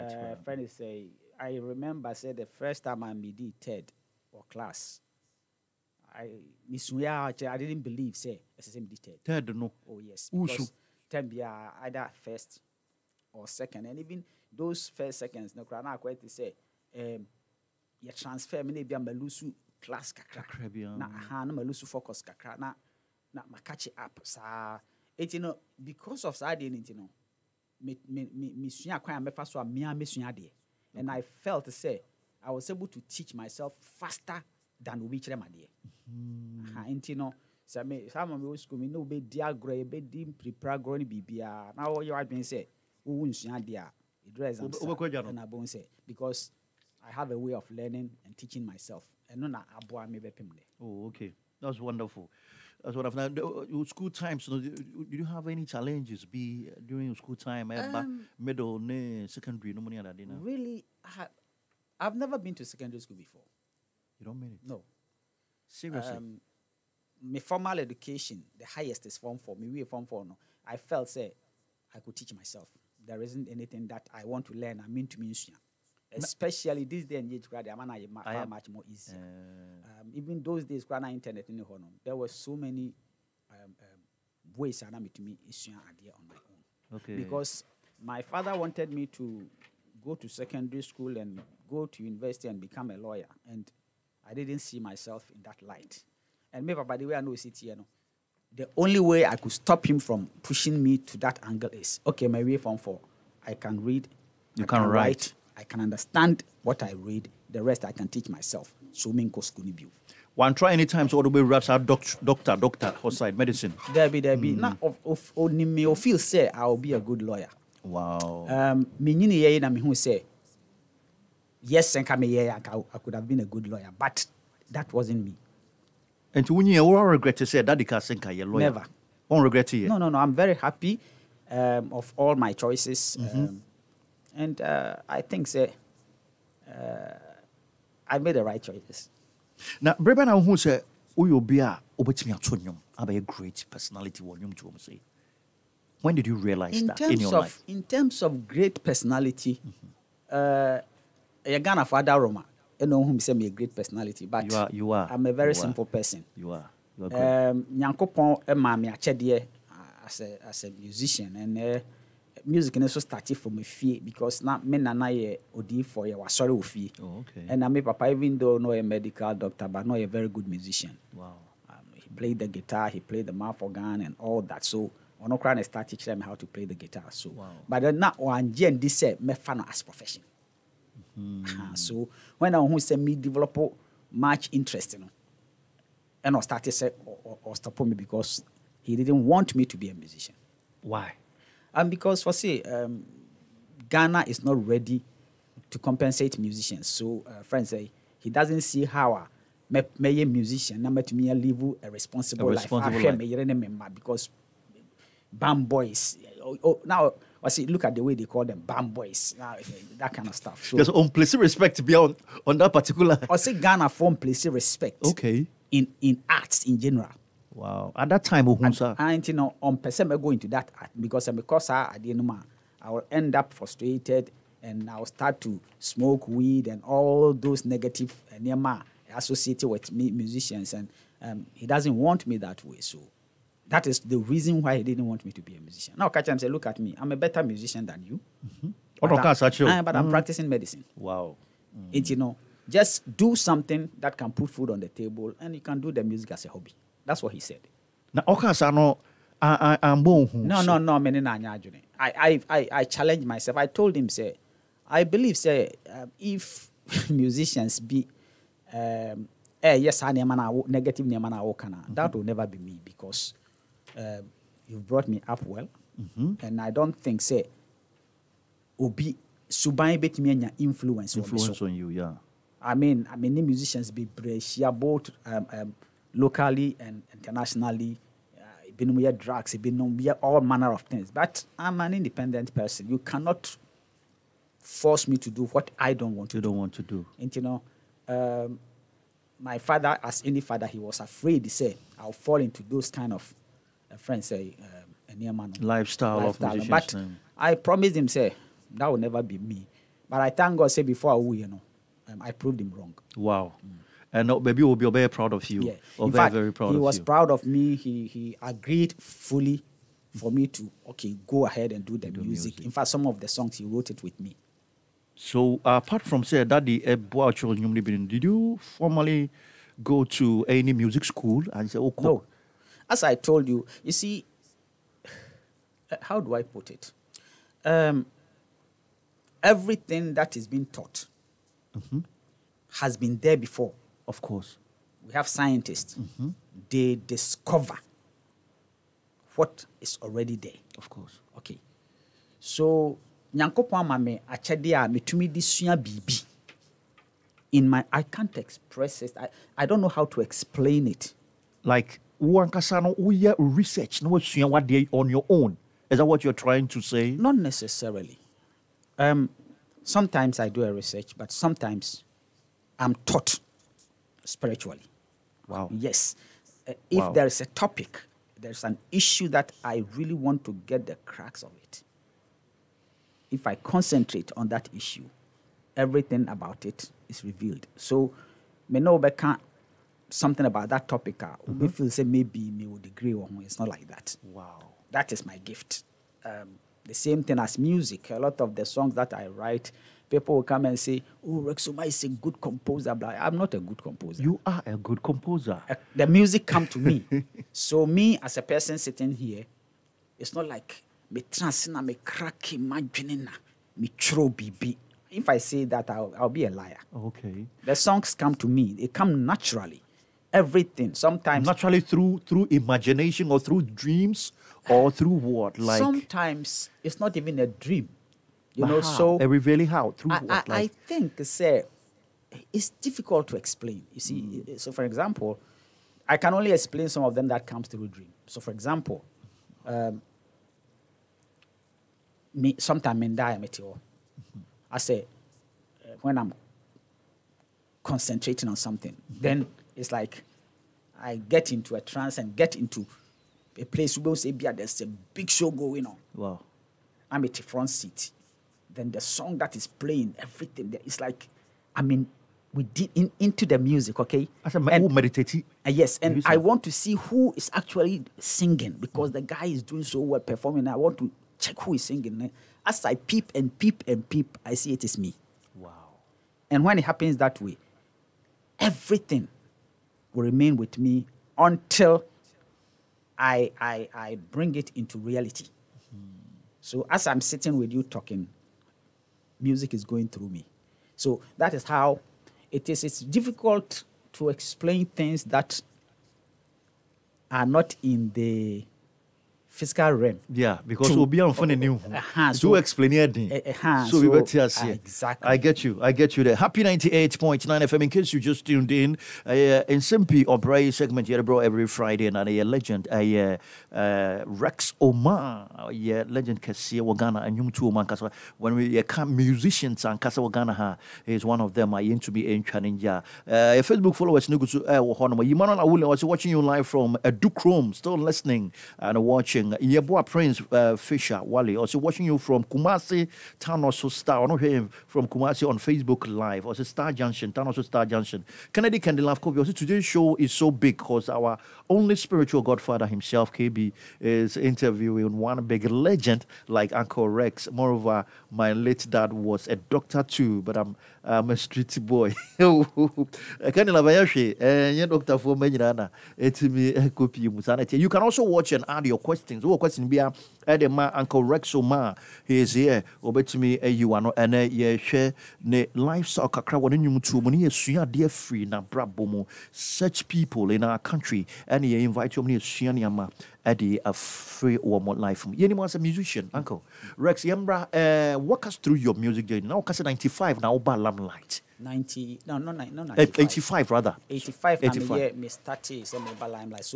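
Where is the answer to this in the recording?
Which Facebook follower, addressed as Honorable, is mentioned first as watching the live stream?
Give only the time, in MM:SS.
08:35.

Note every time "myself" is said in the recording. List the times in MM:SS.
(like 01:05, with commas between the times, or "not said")
00:33, 00:48, 01:12, 01:34, 01:48, 04:13.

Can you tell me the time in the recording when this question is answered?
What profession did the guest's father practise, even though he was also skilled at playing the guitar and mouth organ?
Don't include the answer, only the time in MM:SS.
02:48.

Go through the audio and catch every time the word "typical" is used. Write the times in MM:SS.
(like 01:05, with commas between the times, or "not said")
not said.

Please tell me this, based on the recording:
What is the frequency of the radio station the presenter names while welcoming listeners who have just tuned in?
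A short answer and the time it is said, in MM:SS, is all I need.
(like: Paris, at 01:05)
98.9 FM, at 08:16.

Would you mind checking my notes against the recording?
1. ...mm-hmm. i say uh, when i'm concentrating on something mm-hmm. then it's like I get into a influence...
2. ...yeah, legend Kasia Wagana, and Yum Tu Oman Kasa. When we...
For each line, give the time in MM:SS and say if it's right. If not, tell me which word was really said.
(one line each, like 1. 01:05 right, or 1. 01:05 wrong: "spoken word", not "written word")
1. 07:13 wrong: "trance", not "influence"
2. 08:25 right.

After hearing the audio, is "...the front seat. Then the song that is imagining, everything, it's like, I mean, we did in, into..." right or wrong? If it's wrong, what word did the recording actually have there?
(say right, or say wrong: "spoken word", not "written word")
wrong: "playing", not "imagining".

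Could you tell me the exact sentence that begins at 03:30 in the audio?
So, There's on respect beyond on that particular.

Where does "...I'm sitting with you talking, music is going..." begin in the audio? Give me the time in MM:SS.
07:57.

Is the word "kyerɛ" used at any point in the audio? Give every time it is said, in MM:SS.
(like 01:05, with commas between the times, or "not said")
00:35.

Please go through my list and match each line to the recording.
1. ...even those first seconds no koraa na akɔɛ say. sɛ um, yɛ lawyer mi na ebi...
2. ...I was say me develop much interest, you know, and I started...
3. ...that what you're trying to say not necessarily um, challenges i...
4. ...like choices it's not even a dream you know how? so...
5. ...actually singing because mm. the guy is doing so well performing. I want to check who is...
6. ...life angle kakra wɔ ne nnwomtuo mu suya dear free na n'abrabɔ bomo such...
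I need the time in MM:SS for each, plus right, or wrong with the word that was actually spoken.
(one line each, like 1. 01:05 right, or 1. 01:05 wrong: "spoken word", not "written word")
1. 00:13 wrong: "transfer", not "lawyer"
2. 03:02 right
3. 05:55 wrong: "sometimes", not "challenges"
4. 06:55 wrong: "sometimes", not "choices"
5. 07:37 right
6. 09:15 wrong: "lifestyle", not "angle".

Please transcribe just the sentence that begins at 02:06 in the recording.
And to you all regret to say that i Senka a lawyer.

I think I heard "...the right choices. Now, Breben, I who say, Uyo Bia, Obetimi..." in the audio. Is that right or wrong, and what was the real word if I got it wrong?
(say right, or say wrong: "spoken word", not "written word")
right.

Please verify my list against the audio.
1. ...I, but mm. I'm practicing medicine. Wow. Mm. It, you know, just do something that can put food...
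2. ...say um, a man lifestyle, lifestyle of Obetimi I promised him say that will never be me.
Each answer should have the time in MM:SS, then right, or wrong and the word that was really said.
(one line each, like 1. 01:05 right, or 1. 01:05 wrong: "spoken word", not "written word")
1. 03:59 right
2. 04:54 wrong: "But", not "Obetimi".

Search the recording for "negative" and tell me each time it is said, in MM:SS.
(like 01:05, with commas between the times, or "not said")
03:47, 04:20.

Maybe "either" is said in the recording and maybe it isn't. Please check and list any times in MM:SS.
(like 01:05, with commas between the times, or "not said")
00:11.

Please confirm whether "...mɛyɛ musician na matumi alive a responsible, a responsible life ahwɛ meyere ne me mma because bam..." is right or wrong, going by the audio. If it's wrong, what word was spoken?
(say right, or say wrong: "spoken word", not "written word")
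right.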